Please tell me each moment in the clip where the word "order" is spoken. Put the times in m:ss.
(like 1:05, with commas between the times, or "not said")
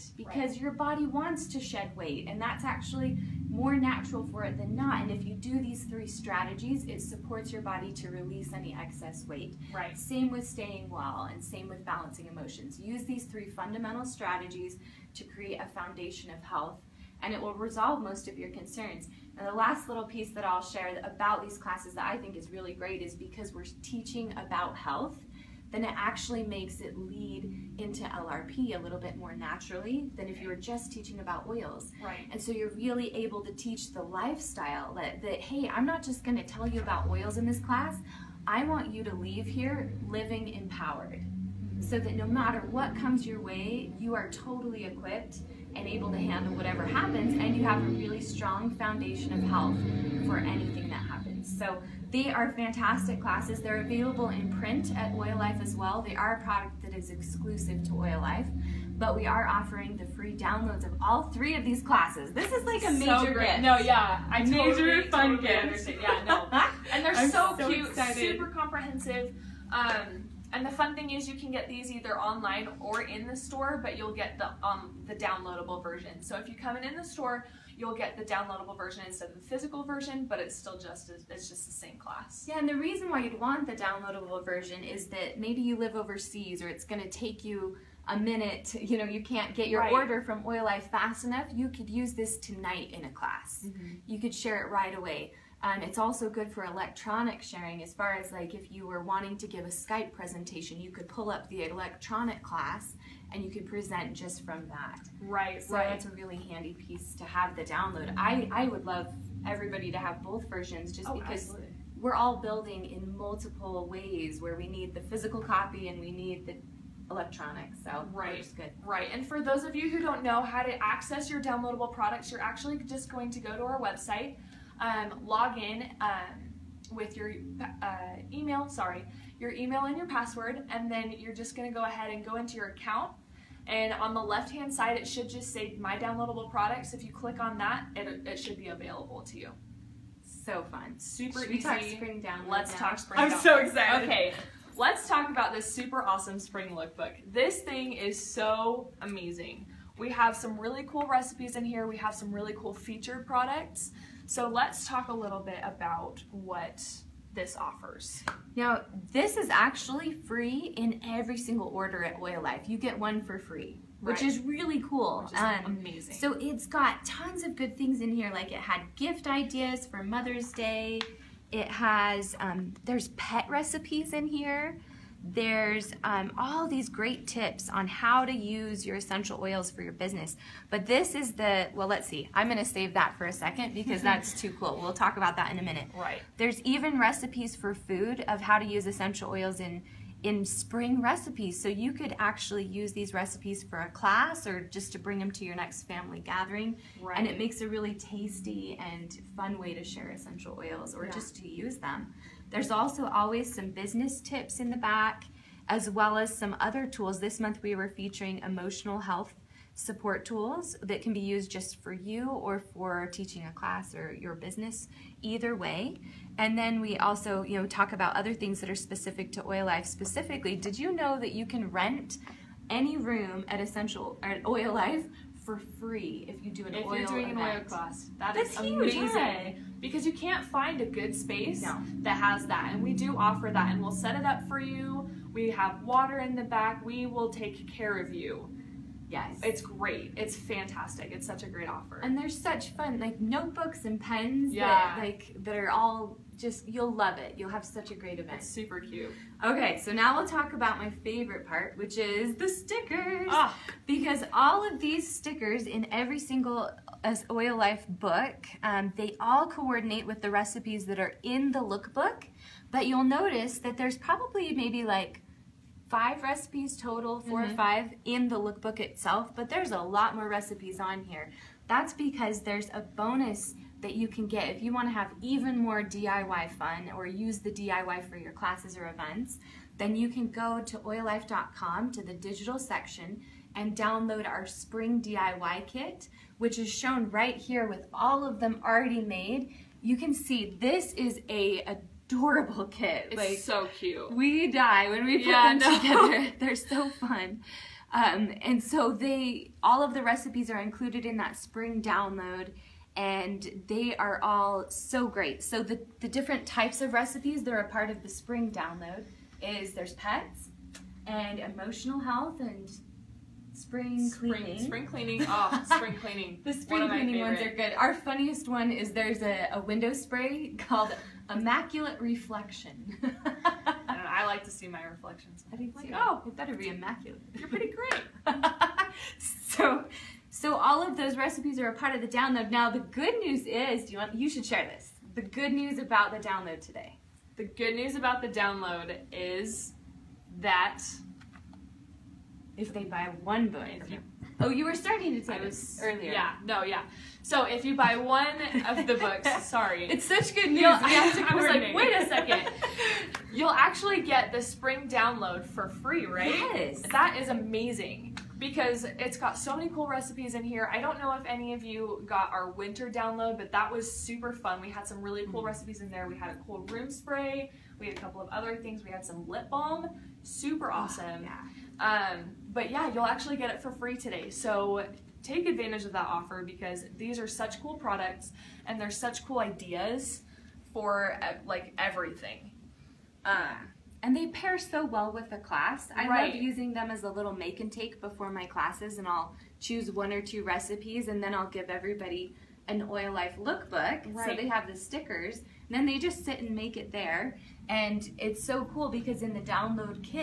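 1:29, 2:41.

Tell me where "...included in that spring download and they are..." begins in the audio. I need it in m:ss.
5:00.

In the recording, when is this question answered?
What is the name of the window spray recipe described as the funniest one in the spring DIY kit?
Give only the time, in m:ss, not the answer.
5:21.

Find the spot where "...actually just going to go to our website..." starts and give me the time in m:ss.
2:02.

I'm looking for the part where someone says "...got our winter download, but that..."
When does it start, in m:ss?
6:02.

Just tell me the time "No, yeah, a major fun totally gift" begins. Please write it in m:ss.
1:03.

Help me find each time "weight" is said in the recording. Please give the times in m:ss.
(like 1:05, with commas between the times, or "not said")
0:01, 0:09.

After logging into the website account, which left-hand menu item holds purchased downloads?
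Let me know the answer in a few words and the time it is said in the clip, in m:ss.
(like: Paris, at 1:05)
My Downloadable Products, at 2:15.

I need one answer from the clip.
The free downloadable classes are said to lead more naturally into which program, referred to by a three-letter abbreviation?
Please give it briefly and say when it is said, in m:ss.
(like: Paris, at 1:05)
LRP, at 0:28.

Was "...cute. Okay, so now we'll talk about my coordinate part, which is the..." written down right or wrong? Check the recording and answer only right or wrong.
wrong.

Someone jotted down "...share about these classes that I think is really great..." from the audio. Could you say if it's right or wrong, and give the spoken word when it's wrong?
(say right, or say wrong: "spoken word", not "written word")
right.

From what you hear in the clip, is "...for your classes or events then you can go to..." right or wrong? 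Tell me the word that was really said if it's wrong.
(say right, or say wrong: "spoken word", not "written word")
right.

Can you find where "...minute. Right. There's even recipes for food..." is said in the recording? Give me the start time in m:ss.
3:05.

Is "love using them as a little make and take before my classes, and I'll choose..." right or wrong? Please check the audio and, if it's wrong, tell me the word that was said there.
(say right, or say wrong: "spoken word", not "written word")
right.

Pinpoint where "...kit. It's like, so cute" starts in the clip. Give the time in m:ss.
4:52.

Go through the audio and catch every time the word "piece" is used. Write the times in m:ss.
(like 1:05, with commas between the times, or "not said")
0:20, 1:46.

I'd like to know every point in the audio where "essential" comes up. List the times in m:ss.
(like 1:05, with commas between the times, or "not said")
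2:58, 3:08, 3:20, 3:43.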